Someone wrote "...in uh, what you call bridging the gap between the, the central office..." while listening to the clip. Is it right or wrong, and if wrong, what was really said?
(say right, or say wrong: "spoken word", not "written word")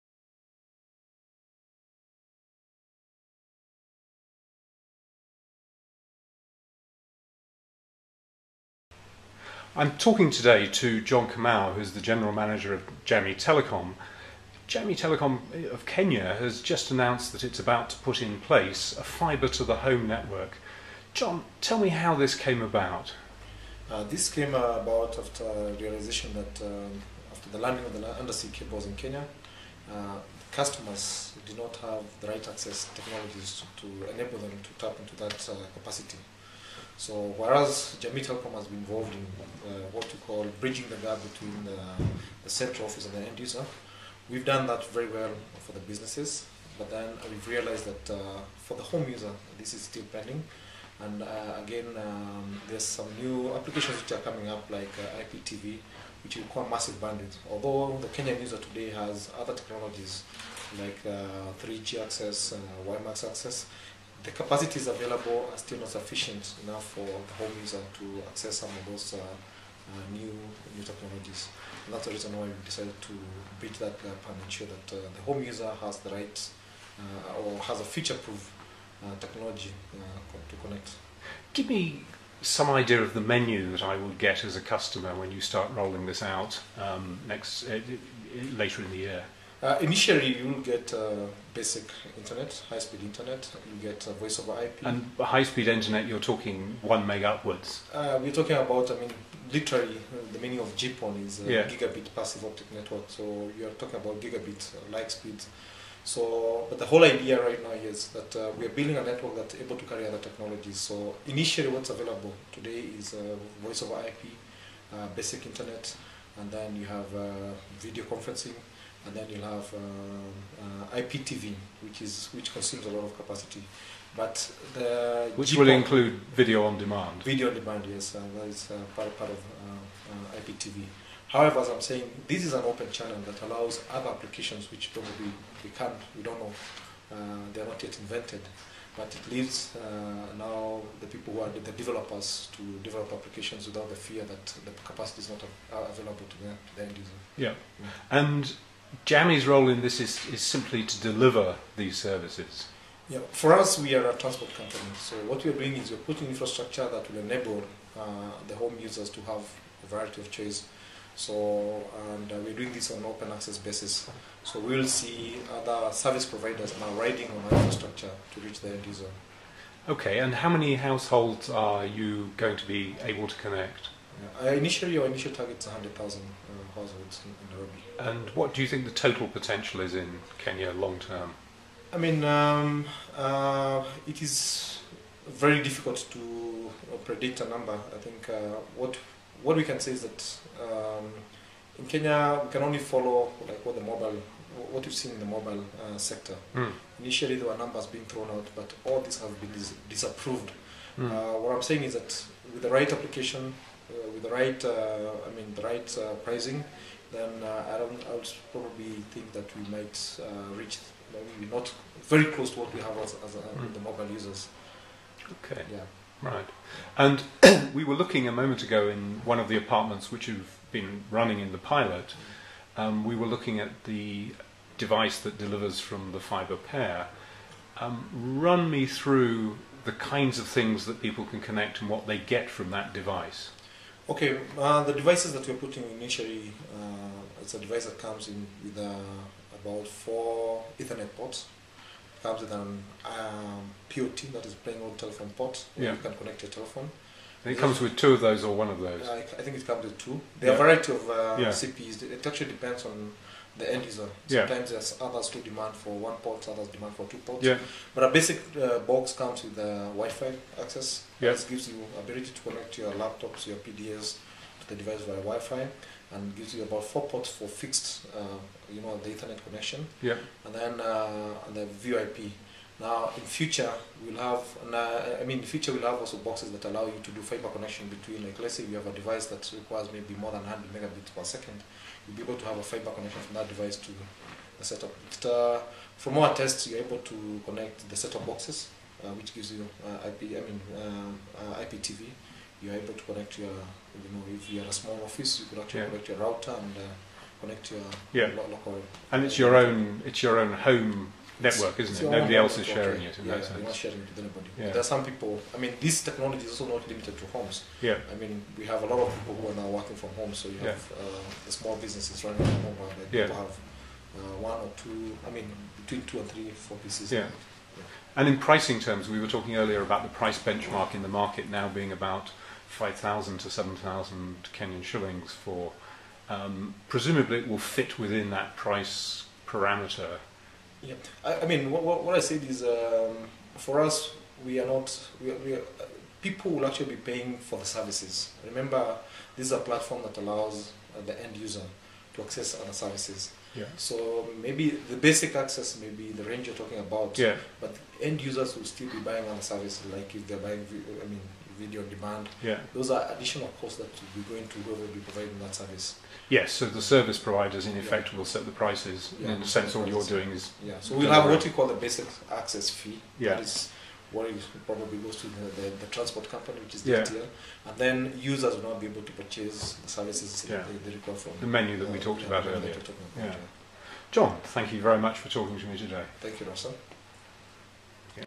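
right.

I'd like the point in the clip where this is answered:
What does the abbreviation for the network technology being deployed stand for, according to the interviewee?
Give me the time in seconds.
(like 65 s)
101 s.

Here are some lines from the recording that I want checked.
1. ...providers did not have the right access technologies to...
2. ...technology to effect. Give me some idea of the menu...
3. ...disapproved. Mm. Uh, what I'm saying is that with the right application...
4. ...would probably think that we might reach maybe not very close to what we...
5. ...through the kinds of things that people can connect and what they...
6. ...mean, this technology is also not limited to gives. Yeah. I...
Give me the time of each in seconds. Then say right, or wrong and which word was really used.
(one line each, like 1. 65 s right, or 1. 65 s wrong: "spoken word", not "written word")
1. 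30 s wrong: "customers", not "providers"
2. 79 s wrong: "connect", not "effect"
3. 199 s right
4. 208 s right
5. 228 s right
6. 305 s wrong: "homes", not "gives".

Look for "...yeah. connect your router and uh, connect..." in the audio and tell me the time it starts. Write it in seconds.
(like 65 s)
295 s.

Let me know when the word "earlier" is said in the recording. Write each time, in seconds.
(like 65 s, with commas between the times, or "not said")
319 s, 372 s.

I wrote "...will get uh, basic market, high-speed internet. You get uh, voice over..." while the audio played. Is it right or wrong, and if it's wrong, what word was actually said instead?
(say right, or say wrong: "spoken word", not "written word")
wrong: "internet", not "market".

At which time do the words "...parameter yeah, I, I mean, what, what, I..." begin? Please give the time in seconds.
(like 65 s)
329 s.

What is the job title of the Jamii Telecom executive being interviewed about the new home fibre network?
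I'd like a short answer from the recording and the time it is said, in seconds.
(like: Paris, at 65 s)
General manager, at 12 s.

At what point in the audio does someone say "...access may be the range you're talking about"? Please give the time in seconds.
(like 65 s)
345 s.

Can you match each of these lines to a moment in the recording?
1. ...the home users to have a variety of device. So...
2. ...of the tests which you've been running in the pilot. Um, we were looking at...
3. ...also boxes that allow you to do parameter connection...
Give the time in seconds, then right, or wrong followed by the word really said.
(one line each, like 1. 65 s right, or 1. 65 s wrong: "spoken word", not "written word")
1. 158 s wrong: "choice", not "device"
2. 219 s wrong: "apartments", not "tests"
3. 275 s wrong: "fiber", not "parameter".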